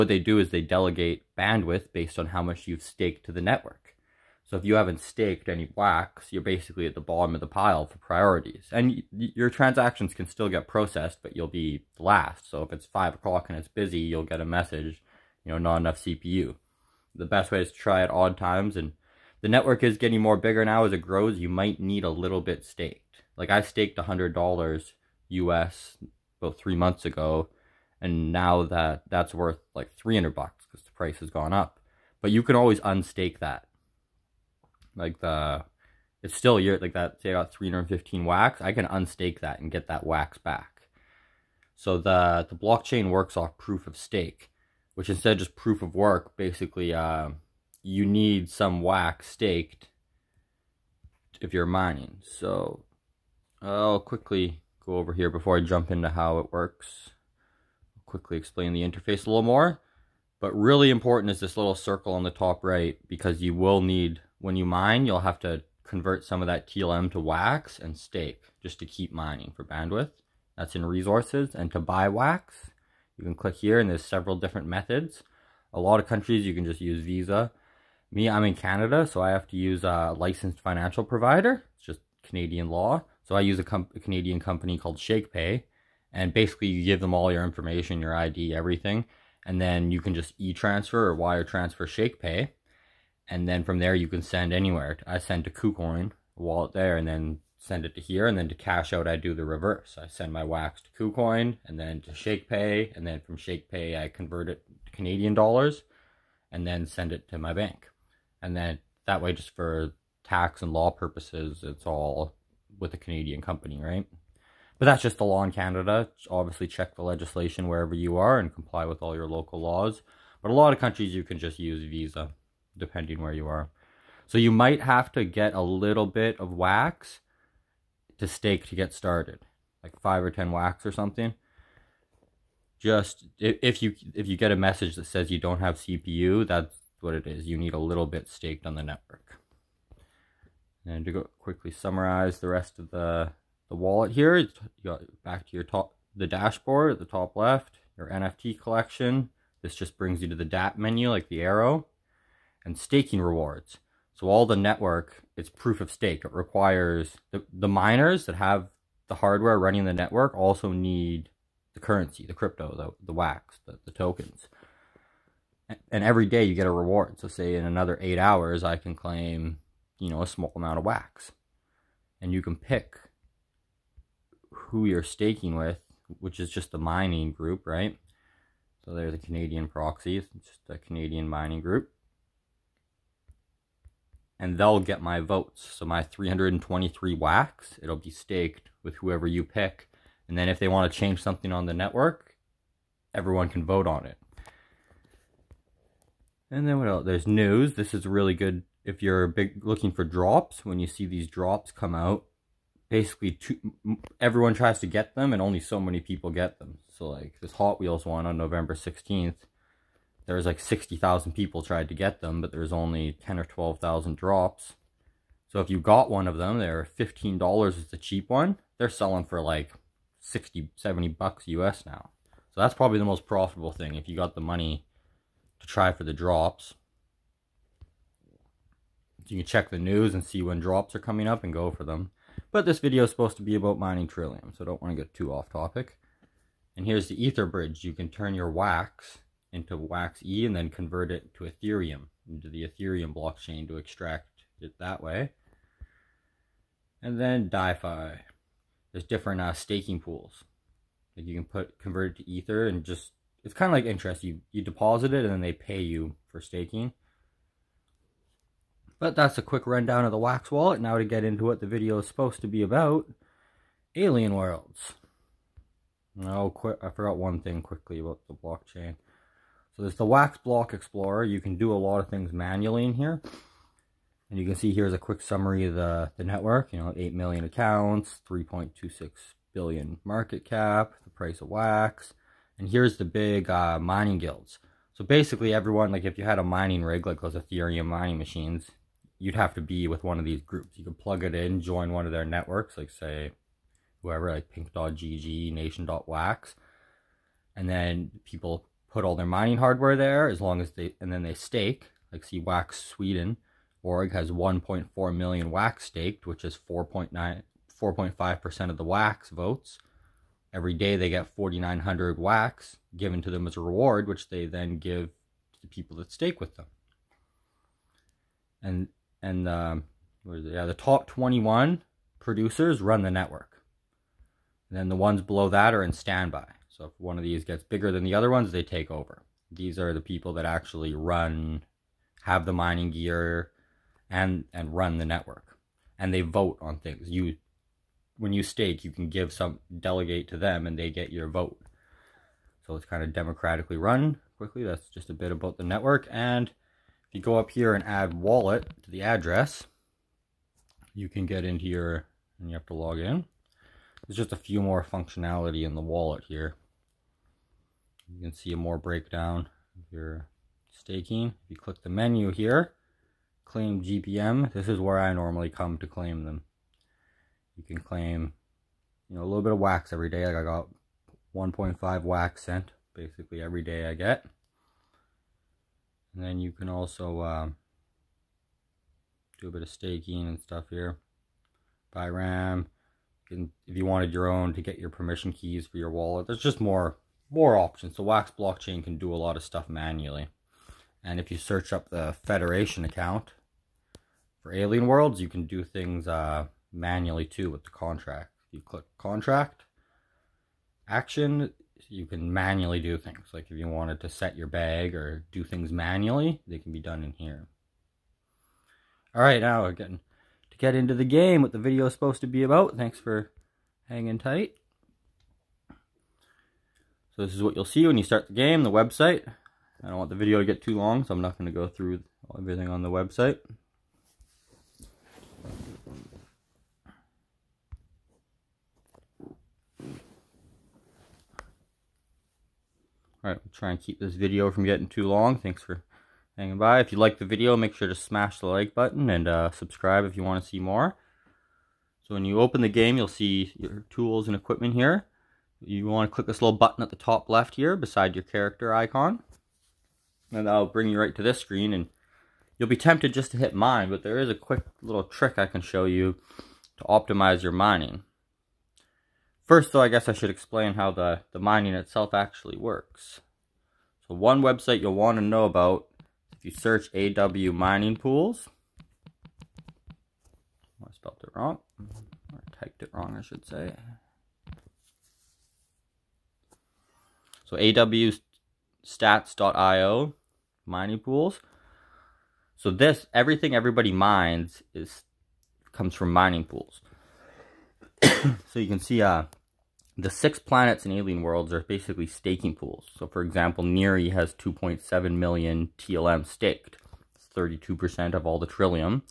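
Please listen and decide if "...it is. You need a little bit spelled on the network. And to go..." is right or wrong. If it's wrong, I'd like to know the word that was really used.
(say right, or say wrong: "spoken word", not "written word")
wrong: "staked", not "spelled".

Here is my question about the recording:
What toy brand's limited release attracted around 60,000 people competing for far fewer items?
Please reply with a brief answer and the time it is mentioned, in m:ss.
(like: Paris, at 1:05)
Hot Wheels, at 3:27.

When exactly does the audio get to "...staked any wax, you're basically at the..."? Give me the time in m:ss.
0:05.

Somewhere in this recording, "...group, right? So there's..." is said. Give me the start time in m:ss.
2:57.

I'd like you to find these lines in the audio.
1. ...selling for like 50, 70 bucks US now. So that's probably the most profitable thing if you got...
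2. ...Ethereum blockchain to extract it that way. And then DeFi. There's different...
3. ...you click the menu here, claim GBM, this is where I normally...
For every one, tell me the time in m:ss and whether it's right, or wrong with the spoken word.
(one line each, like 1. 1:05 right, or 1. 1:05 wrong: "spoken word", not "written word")
1. 3:38 wrong: "60", not "50"
2. 4:02 right
3. 6:01 right.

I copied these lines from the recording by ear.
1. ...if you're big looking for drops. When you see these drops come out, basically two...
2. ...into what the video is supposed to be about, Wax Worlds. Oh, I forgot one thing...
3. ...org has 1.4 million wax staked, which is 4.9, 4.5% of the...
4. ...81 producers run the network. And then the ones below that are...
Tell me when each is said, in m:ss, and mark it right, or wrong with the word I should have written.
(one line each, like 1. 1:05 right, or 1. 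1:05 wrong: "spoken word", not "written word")
1. 3:18 right
2. 4:21 wrong: "Alien", not "Wax"
3. 5:03 right
4. 5:21 wrong: "21", not "81".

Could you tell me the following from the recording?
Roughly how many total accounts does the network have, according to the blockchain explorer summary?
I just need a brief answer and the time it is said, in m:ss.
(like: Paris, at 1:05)
8 million, at 4:36.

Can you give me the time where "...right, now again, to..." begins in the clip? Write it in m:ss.
6:49.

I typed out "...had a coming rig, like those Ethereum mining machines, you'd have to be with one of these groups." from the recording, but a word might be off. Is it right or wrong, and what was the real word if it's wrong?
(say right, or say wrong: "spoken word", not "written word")
wrong: "mining", not "coming".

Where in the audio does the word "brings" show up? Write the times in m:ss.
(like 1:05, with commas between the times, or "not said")
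2:29, 7:30.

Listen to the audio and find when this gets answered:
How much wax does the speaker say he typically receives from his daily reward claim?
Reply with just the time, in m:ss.
6:11.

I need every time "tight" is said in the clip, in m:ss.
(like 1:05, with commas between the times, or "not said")
6:54.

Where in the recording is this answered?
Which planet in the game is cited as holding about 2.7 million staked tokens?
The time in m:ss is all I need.
8:13.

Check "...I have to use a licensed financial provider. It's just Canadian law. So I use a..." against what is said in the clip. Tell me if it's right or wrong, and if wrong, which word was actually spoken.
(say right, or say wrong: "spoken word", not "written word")
right.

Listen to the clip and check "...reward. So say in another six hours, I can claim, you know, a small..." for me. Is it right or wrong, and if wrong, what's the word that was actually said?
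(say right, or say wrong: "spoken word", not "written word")
wrong: "eight", not "six".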